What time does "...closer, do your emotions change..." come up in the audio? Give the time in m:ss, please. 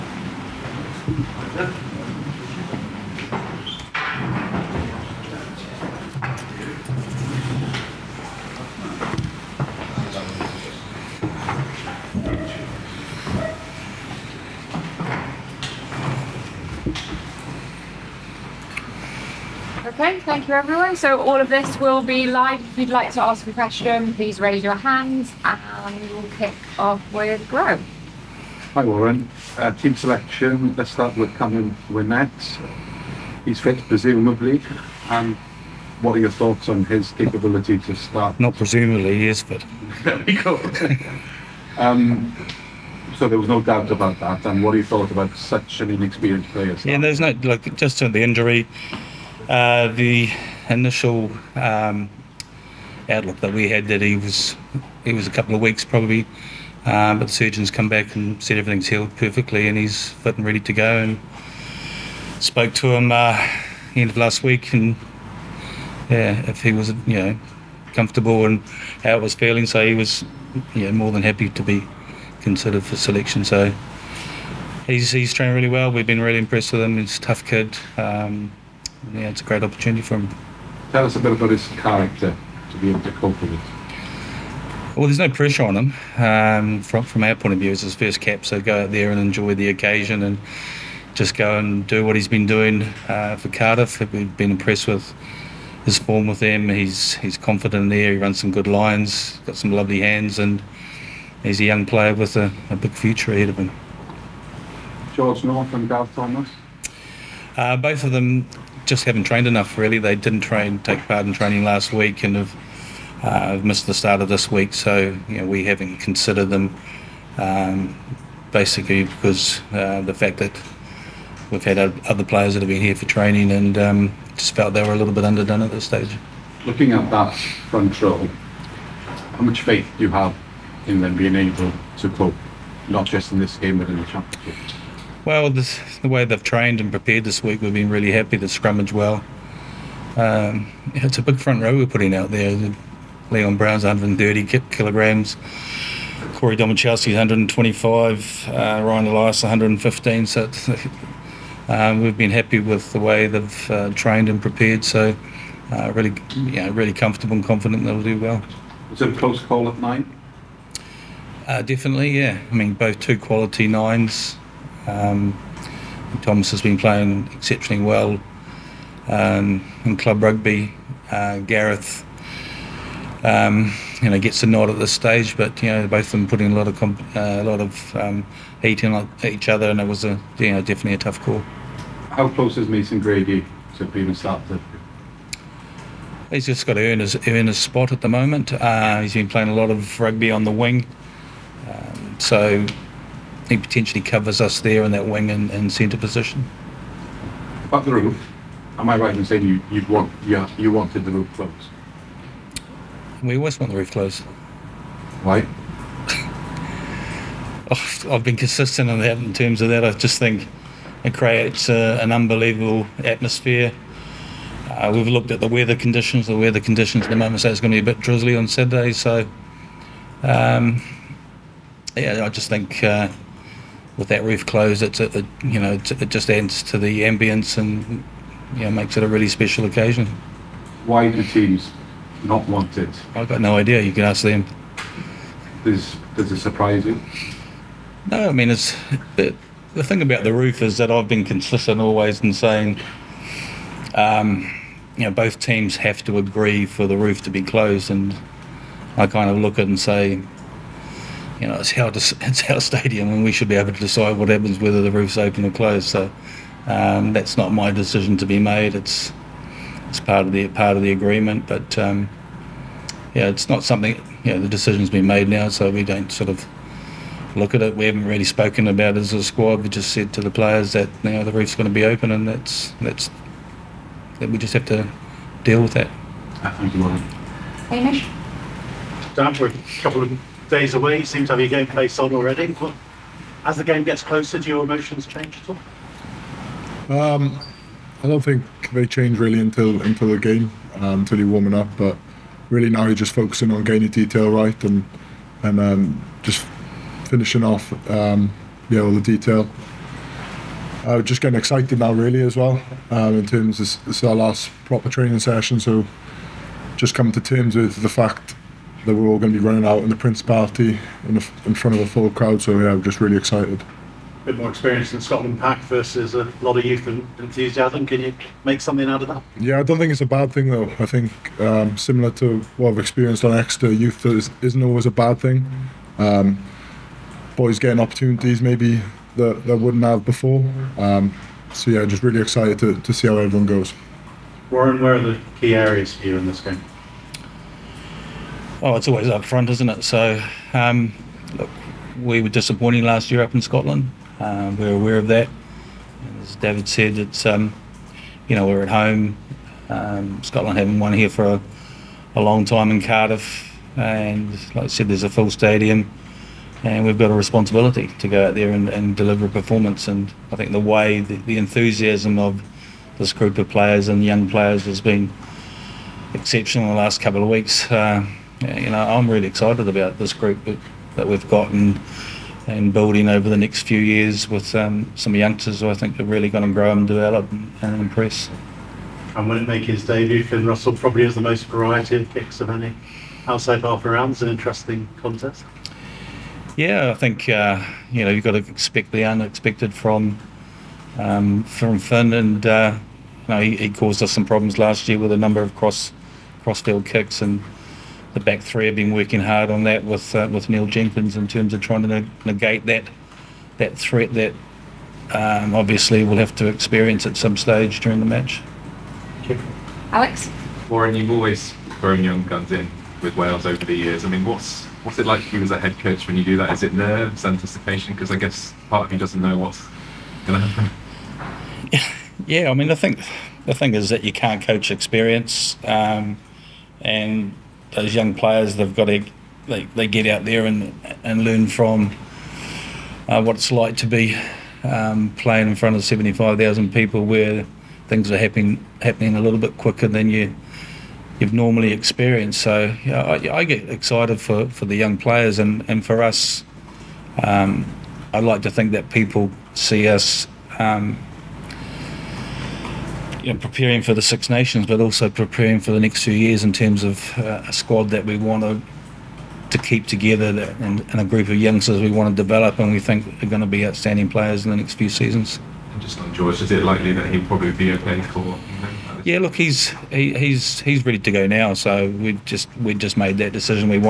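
4:44.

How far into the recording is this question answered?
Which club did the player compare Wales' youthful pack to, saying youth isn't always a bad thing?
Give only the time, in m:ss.
5:23.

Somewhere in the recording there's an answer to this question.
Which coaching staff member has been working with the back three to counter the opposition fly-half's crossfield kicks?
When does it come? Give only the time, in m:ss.
6:40.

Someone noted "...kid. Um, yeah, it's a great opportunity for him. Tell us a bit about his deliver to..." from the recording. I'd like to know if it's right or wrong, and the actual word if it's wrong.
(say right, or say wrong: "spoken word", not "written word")
wrong: "character", not "deliver".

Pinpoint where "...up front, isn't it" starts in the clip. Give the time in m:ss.
5:39.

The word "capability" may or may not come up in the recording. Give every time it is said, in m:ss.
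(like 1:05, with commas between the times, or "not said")
0:37.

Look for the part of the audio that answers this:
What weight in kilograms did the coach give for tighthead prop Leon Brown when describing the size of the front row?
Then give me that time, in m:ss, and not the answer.
2:23.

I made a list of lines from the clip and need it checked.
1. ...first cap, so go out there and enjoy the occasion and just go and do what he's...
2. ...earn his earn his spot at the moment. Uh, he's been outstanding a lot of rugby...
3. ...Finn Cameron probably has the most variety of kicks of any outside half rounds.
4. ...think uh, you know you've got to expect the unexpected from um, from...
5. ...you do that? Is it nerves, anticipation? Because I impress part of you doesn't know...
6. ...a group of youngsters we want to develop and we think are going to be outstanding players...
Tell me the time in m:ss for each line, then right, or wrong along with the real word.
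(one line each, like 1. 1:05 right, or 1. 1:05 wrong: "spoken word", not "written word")
1. 1:27 right
2. 3:06 wrong: "playing", not "outstanding"
3. 6:20 wrong: "Russell", not "Cameron"
4. 6:26 right
5. 6:56 wrong: "guess", not "impress"
6. 7:40 right.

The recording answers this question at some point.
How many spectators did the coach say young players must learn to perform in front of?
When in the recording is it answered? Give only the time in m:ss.
7:15.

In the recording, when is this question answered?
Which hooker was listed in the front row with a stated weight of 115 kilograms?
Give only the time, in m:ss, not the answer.
2:28.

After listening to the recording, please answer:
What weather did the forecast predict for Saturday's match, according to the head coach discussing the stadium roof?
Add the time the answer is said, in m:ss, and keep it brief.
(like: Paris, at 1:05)
Drizzly, at 3:38.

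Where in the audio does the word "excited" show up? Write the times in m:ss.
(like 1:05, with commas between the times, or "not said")
5:01, 5:13, 5:32, 6:09, 7:23.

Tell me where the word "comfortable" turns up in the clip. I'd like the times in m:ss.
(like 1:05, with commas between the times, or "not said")
1:07, 2:36.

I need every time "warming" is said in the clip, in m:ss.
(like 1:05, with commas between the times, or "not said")
4:51.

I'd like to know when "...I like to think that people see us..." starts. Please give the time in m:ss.
7:28.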